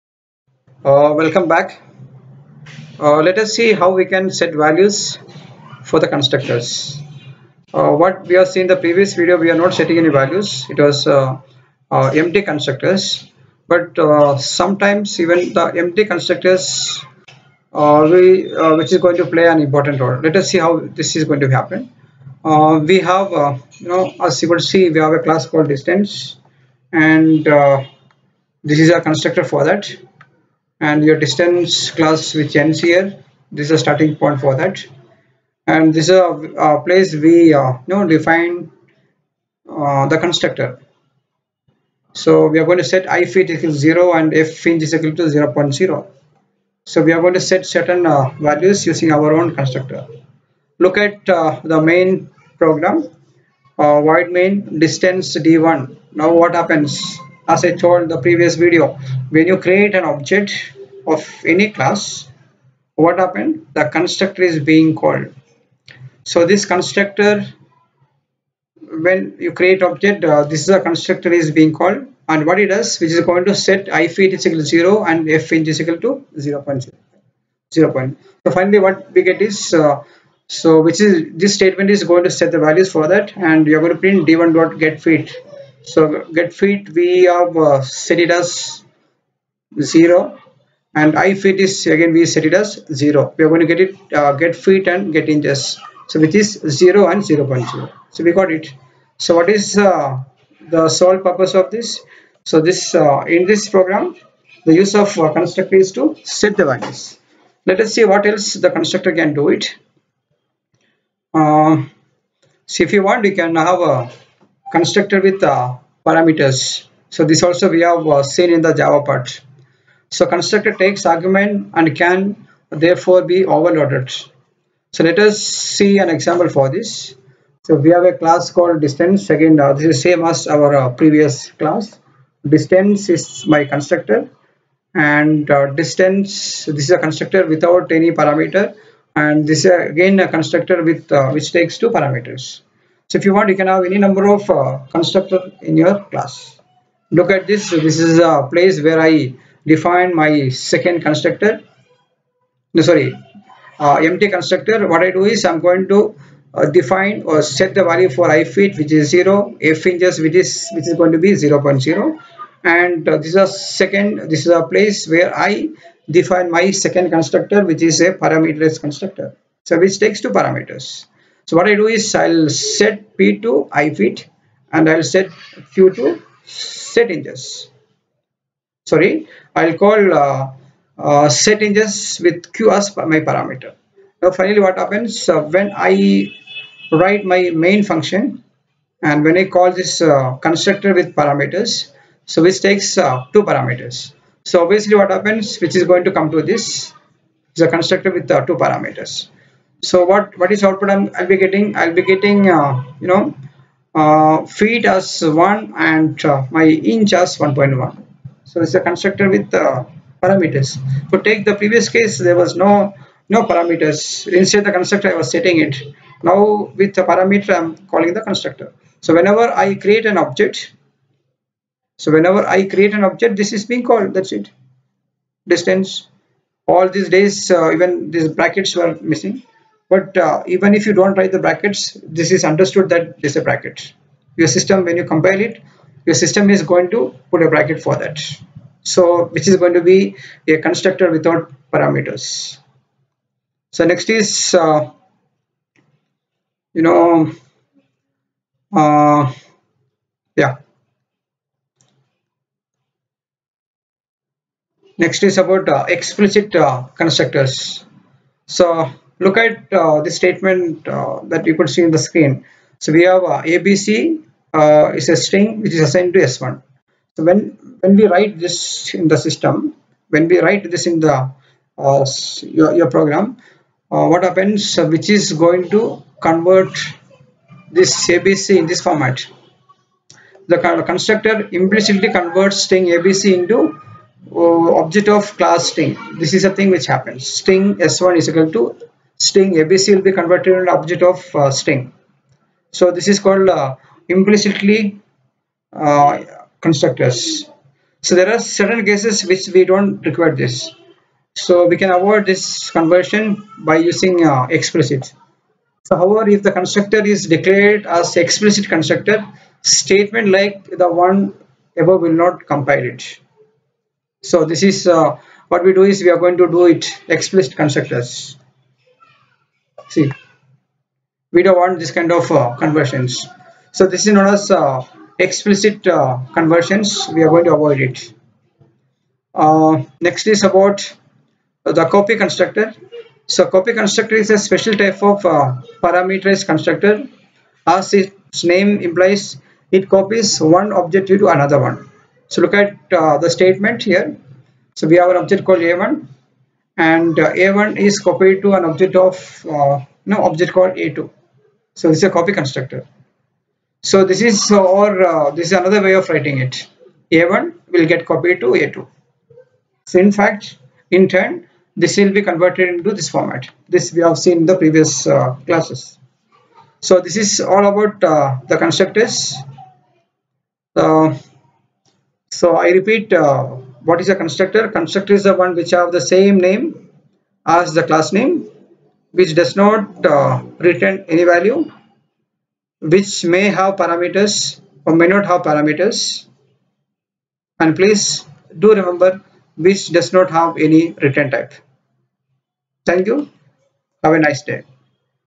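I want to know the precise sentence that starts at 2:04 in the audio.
So let us see an example for this.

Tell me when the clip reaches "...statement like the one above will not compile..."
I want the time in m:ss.
5:09.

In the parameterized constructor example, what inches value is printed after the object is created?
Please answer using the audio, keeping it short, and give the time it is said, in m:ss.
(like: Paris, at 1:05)
1.1, at 3:27.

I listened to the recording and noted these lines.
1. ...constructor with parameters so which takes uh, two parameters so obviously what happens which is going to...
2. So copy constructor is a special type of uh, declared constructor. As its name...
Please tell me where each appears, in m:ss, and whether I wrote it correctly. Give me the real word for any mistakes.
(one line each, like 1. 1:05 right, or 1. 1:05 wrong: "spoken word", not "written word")
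1. 3:10 right
2. 5:33 wrong: "parameterized", not "declared".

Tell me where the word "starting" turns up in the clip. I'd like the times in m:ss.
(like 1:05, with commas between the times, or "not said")
0:33.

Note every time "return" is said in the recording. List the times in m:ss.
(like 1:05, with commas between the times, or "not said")
6:20, 6:31.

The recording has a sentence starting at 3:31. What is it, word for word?
So take the previous case, there was no no parameters.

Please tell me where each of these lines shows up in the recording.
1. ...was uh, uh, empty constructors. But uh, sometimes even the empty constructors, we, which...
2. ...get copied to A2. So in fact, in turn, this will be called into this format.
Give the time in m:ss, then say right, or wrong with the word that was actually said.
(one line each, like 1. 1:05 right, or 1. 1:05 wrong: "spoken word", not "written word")
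1. 0:10 right
2. 5:57 wrong: "converted", not "called".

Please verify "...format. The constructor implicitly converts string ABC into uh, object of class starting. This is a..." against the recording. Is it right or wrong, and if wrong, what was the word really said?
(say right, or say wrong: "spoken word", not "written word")
wrong: "string", not "starting".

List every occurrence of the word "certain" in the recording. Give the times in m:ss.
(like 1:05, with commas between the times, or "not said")
0:47, 4:58.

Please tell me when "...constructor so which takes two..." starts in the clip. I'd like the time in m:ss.
2:48.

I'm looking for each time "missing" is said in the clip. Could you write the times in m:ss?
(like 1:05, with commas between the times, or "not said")
3:48.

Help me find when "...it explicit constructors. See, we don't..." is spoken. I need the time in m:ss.
5:16.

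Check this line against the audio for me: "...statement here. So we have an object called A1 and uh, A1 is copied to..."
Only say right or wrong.
right.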